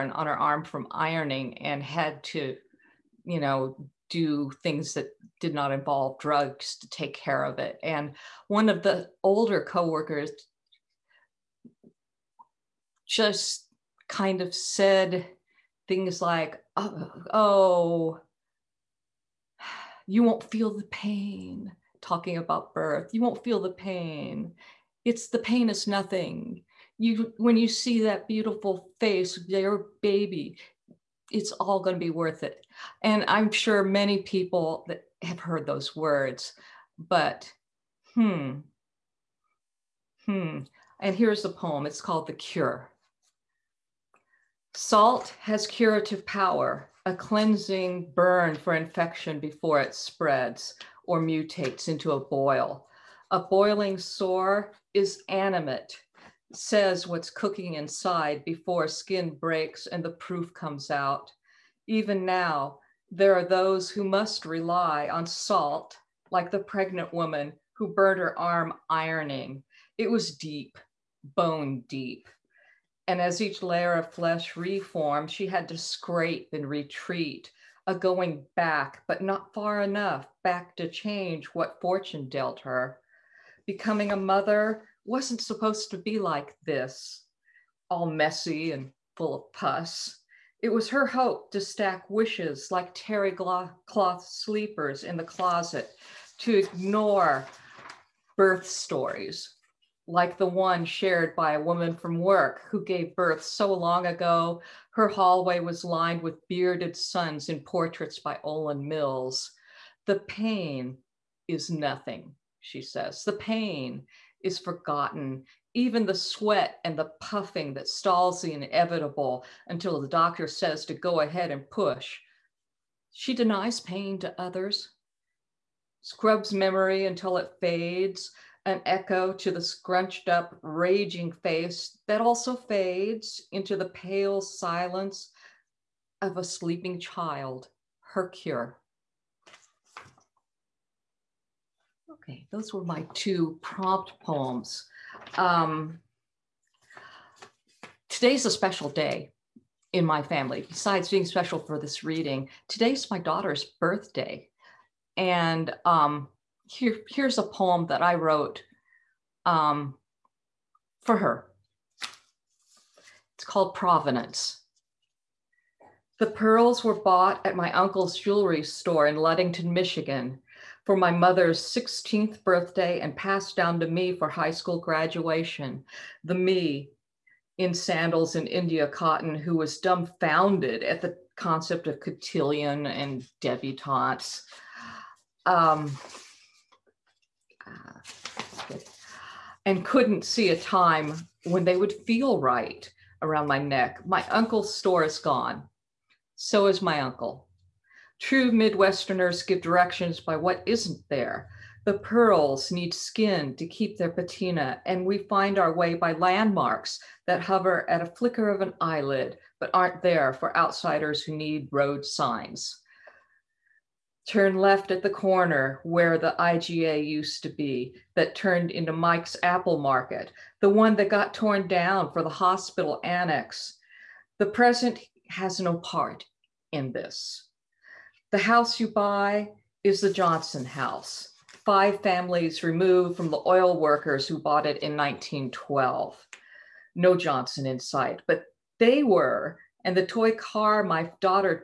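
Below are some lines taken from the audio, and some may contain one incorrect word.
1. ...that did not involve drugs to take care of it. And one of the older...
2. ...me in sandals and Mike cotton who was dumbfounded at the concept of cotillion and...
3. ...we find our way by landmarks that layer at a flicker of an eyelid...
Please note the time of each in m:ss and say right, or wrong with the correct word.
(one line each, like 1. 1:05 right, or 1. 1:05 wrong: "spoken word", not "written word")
1. 0:04 right
2. 2:56 wrong: "India", not "Mike"
3. 3:25 wrong: "hover", not "layer".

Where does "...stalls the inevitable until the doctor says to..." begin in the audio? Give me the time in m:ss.
1:57.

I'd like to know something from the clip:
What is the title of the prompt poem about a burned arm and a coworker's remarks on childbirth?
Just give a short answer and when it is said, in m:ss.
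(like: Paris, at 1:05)
The Cure, at 0:42.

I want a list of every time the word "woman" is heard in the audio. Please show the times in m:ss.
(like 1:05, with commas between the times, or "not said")
1:07, 1:41.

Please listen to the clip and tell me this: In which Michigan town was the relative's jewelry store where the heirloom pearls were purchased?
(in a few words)
Ludington.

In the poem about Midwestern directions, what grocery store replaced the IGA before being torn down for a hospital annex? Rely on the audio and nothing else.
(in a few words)
Mike's Apple Market.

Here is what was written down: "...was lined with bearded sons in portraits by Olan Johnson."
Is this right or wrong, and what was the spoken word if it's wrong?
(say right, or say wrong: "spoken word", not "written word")
wrong: "Mills", not "Johnson".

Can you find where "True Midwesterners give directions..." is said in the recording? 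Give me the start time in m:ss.
3:18.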